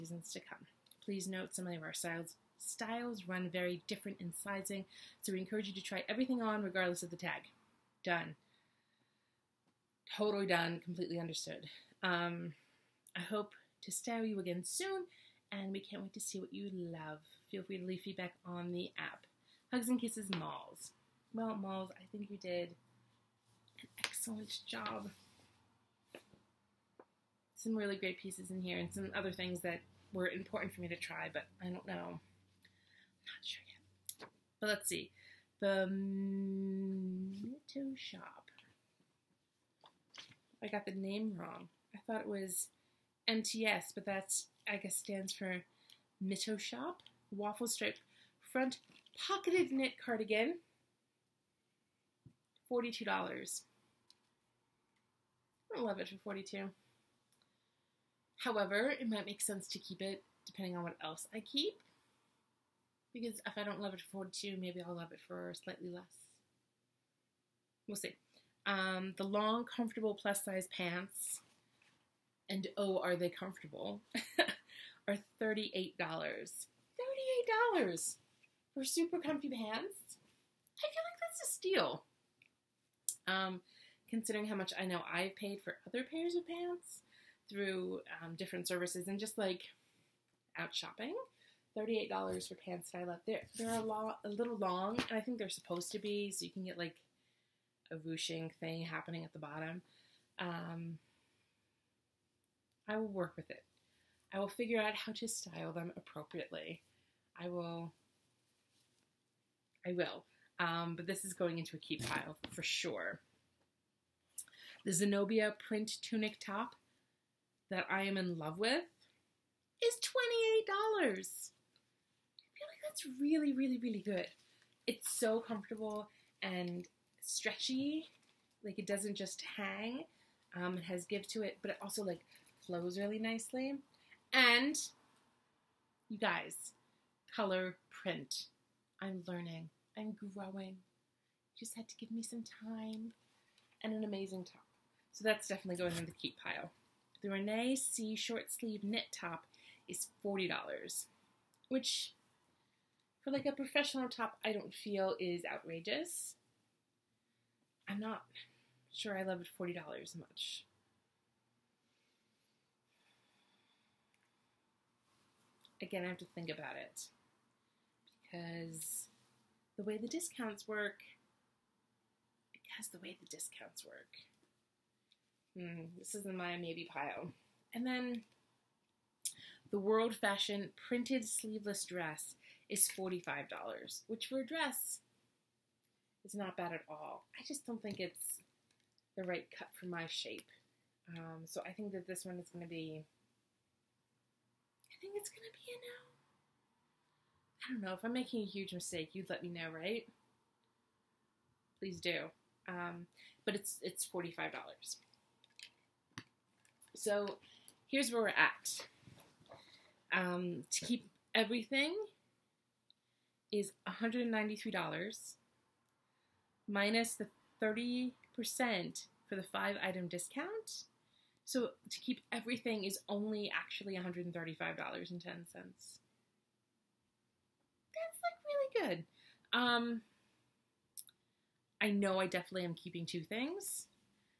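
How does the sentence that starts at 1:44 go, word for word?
I will figure out how to style them appropriately.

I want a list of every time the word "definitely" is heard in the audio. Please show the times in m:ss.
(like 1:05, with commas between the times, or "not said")
2:25, 3:52.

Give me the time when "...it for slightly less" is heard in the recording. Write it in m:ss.
1:05.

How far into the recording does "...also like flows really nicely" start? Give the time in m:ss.
2:11.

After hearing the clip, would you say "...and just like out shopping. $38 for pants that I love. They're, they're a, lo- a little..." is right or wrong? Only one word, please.
right.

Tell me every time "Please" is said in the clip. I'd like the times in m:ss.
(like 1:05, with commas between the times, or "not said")
0:01, 3:21.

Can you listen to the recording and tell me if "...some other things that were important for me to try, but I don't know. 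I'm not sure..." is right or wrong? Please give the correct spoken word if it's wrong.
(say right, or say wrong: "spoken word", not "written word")
right.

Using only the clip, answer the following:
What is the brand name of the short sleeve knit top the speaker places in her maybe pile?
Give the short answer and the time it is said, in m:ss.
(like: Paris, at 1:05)
Renee C, at 2:27.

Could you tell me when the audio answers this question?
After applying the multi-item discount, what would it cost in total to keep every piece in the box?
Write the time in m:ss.
3:43.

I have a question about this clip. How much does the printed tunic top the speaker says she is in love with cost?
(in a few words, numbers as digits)
$28.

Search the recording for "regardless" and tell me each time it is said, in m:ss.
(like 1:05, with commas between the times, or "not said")
0:06.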